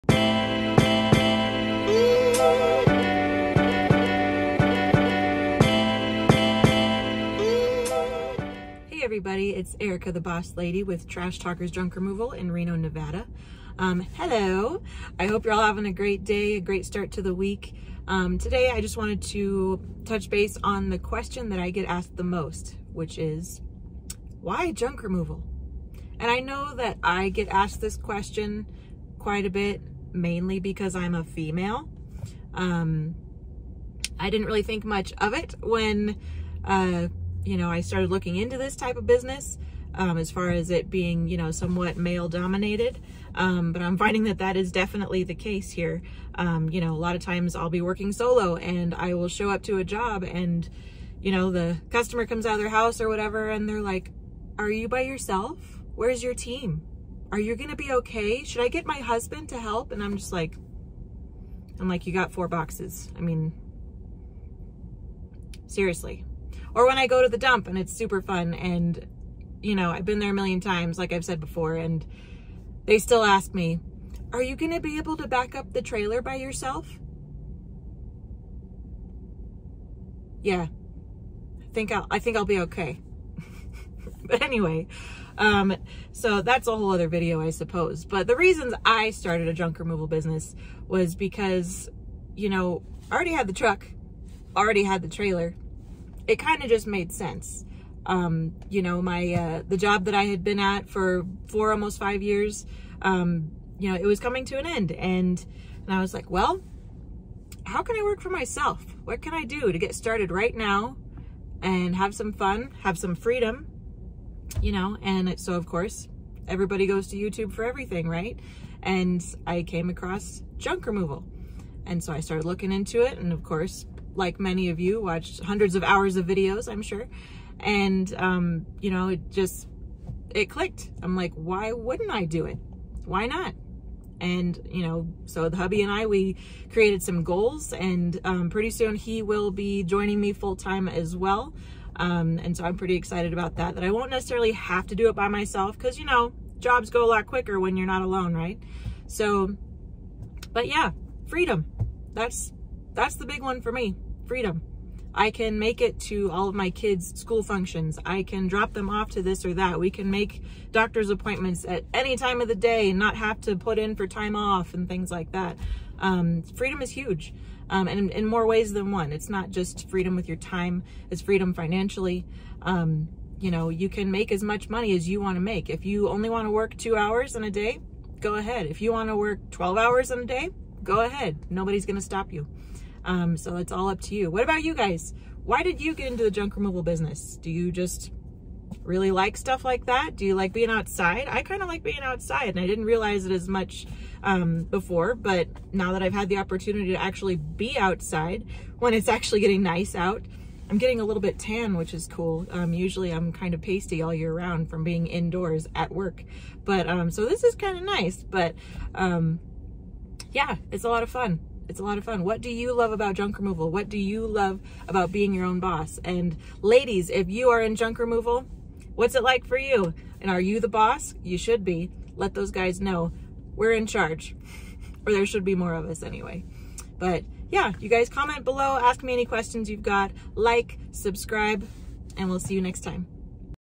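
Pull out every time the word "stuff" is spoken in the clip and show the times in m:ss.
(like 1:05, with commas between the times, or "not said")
3:09.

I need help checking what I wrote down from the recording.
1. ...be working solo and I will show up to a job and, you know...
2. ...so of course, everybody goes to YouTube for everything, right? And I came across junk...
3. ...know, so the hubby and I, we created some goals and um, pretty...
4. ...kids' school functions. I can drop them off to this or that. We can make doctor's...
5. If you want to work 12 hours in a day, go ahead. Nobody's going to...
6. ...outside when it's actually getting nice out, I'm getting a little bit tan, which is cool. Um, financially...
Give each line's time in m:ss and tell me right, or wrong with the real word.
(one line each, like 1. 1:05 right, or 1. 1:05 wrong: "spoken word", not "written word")
1. 0:47 right
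2. 1:55 right
3. 2:14 right
4. 2:36 right
5. 2:58 right
6. 3:17 wrong: "usually", not "financially".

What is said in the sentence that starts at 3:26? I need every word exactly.
But um, so this is kind of nice, but um, yeah, it's a lot of fun.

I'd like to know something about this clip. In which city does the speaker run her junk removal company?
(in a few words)
Reno, Nevada.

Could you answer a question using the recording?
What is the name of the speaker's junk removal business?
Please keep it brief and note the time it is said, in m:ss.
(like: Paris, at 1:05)
Trash Talkers Junk Removal, at 0:11.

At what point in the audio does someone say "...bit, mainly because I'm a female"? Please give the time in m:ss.
0:29.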